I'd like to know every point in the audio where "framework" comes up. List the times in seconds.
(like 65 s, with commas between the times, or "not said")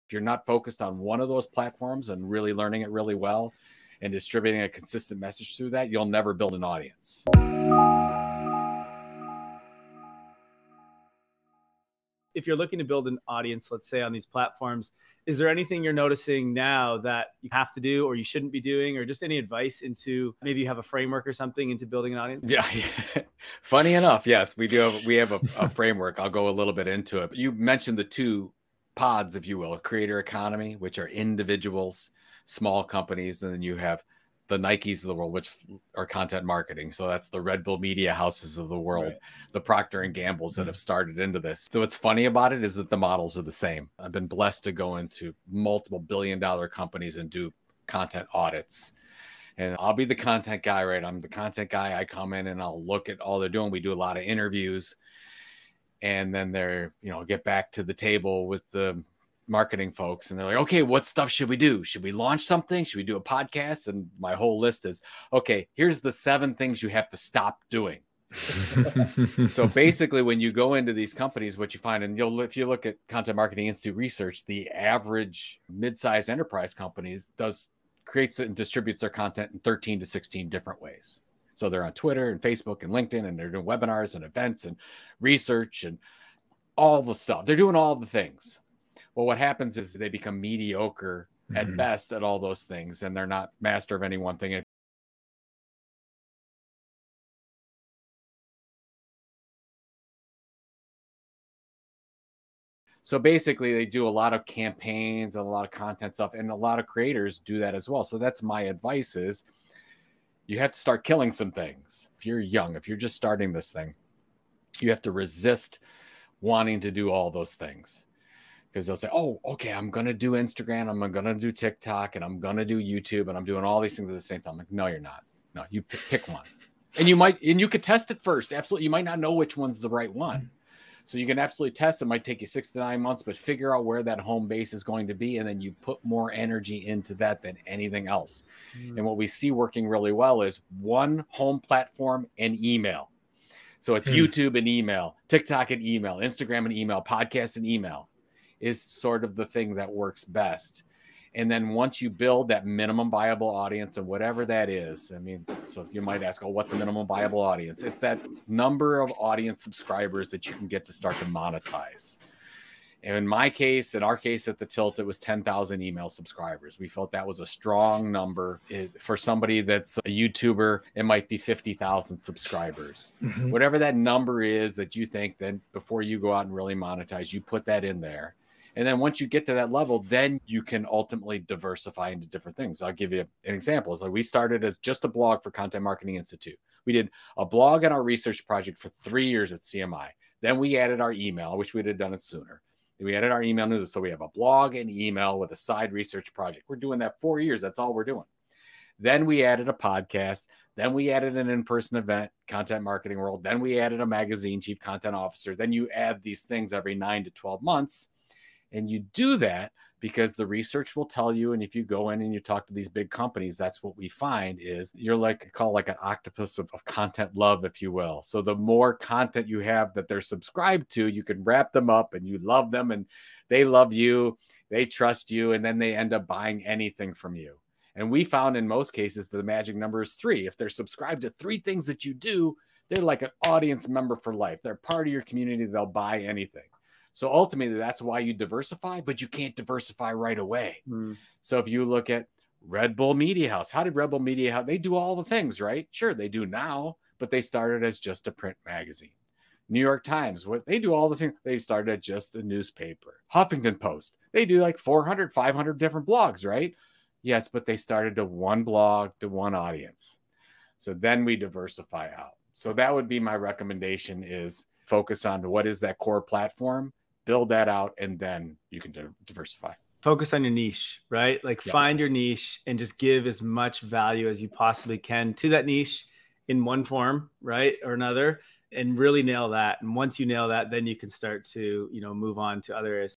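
20 s, 25 s.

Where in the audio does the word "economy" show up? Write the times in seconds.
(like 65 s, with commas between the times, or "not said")
30 s.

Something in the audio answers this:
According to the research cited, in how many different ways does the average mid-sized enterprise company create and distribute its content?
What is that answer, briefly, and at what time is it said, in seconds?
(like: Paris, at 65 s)
13 to 16, at 79 s.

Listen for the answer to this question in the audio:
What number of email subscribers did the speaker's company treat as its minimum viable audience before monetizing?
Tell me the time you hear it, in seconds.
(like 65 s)
165 s.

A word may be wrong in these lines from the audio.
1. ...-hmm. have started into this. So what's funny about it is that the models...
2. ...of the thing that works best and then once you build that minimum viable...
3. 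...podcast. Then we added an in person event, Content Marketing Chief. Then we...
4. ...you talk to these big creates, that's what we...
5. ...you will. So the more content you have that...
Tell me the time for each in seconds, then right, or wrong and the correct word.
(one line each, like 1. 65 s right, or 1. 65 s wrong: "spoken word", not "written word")
1. 40 s right
2. 149 s right
3. 199 s wrong: "World", not "Chief"
4. 212 s wrong: "companies", not "creates"
5. 217 s right.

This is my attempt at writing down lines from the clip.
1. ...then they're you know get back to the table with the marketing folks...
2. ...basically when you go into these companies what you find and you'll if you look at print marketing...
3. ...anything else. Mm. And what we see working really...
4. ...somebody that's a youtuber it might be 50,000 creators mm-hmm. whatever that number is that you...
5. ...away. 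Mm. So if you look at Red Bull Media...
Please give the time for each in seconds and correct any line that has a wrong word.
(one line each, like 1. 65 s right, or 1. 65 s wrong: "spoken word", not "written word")
1. 56 s right
2. 69 s wrong: "content", not "print"
3. 137 s right
4. 169 s wrong: "subscribers", not "creators"
5. 240 s right.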